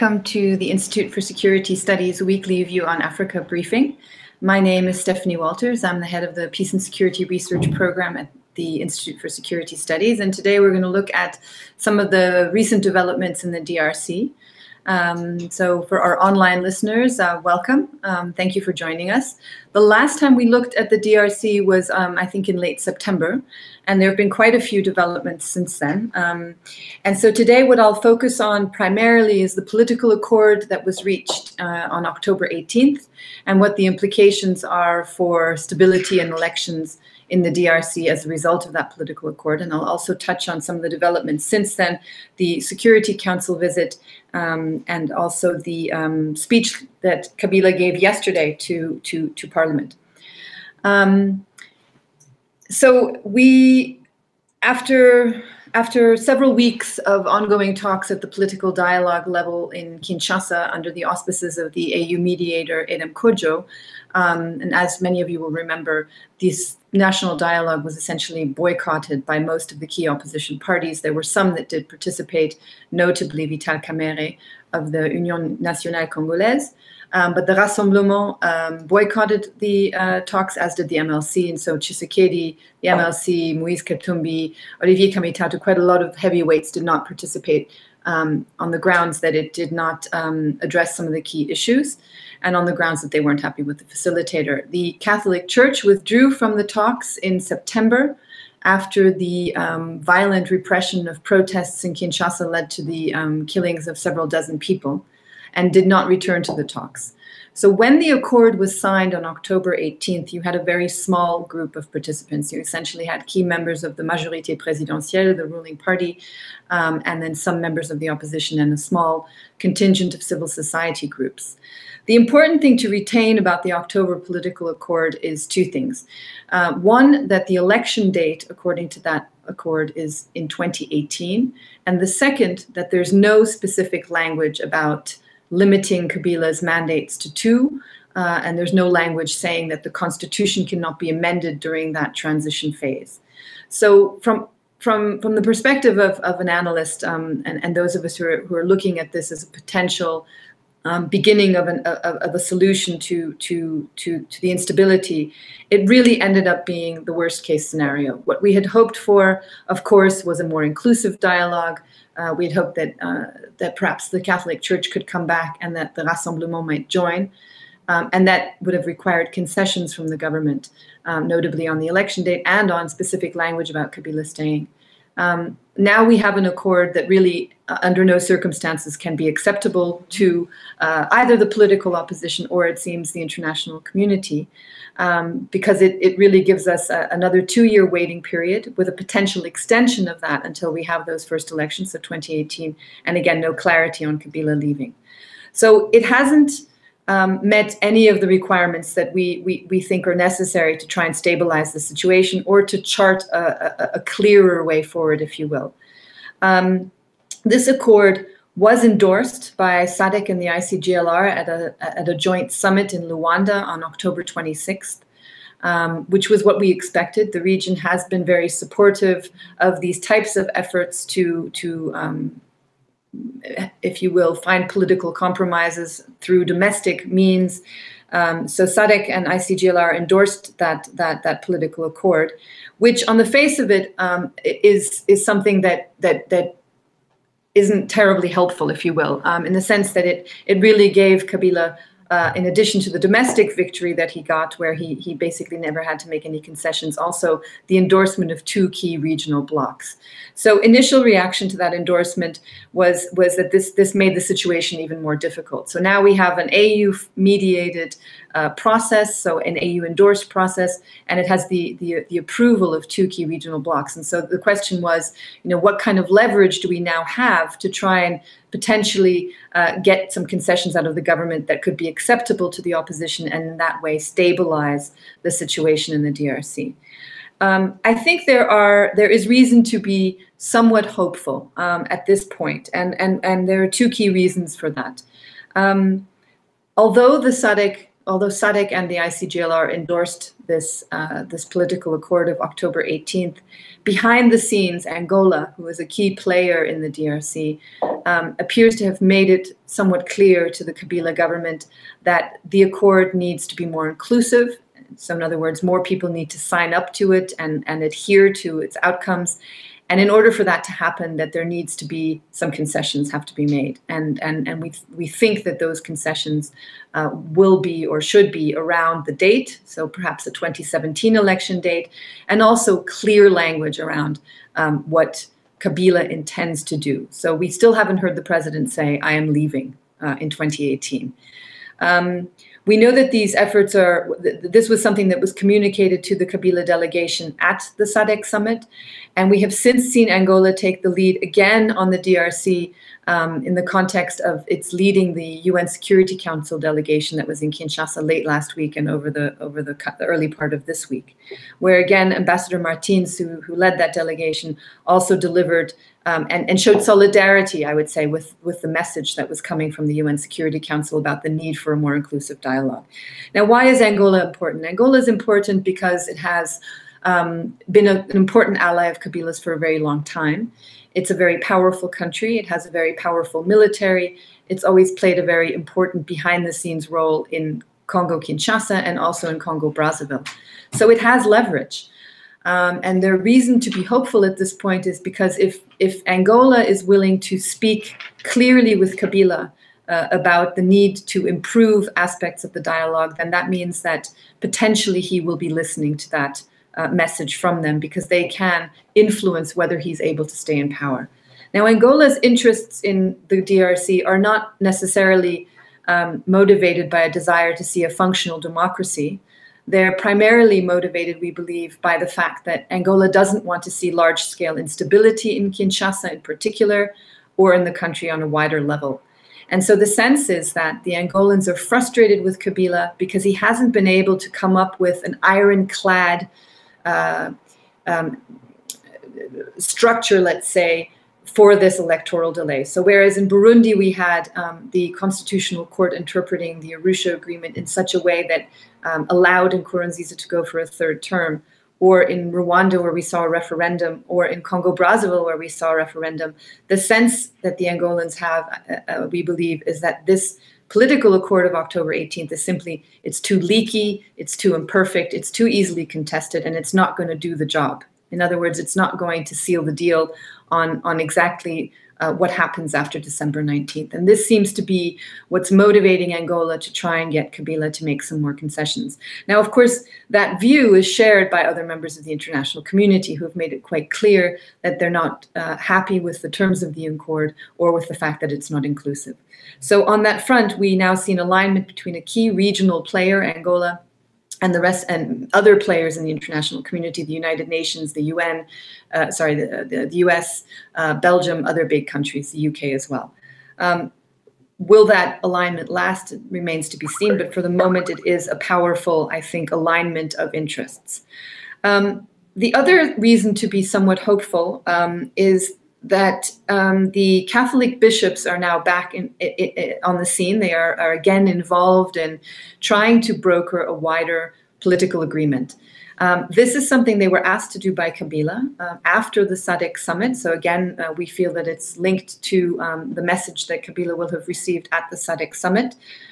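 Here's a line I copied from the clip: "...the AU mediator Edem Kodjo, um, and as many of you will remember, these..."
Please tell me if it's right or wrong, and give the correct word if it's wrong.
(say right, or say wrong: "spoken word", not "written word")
right.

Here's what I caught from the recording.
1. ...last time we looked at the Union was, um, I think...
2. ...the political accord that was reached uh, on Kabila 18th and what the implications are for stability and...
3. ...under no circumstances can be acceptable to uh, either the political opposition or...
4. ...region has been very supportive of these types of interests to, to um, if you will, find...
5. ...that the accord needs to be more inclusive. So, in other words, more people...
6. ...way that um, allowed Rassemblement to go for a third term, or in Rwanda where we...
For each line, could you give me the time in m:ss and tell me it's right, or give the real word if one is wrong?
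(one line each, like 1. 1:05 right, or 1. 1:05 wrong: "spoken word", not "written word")
1. 0:19 wrong: "DRC", not "Union"
2. 0:29 wrong: "October", not "Kabila"
3. 2:57 right
4. 3:37 wrong: "efforts", not "interests"
5. 5:02 right
6. 7:18 wrong: "Nkurunziza", not "Rassemblement".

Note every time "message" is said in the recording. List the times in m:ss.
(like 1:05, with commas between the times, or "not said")
5:58, 6:36, 8:43.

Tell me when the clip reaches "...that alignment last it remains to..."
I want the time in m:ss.
8:14.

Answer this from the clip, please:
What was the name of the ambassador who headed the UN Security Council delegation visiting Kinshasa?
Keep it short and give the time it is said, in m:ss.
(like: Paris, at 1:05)
Martins, at 5:52.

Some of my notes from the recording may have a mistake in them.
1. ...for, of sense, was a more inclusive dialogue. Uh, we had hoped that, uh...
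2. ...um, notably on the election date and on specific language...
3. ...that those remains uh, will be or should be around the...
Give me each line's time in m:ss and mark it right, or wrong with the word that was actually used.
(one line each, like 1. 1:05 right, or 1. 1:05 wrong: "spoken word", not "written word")
1. 2:38 wrong: "course", not "sense"
2. 2:51 right
3. 5:15 wrong: "concessions", not "remains".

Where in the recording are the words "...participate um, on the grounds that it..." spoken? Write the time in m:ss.
1:27.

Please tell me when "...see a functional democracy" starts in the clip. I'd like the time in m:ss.
6:47.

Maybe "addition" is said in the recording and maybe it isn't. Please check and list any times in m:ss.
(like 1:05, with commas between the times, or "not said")
4:02.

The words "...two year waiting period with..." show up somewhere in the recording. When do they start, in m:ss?
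3:07.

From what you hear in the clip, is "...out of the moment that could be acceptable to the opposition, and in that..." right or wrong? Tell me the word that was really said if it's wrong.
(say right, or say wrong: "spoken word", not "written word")
wrong: "government", not "moment".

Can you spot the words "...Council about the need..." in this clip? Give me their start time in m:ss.
6:00.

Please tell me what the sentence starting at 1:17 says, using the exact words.
Um, but the Rassemblement um, boycotted the uh, talks, as did the MLC.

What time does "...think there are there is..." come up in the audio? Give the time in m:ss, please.
4:37.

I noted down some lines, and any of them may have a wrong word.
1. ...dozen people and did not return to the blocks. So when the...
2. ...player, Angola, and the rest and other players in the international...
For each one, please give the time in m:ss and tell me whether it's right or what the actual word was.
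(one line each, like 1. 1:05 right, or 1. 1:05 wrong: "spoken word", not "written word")
1. 1:44 wrong: "talks", not "blocks"
2. 8:02 right.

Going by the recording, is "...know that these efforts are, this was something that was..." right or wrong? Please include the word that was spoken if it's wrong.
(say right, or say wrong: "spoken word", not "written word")
right.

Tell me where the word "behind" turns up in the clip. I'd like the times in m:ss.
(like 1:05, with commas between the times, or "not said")
4:53, 6:16.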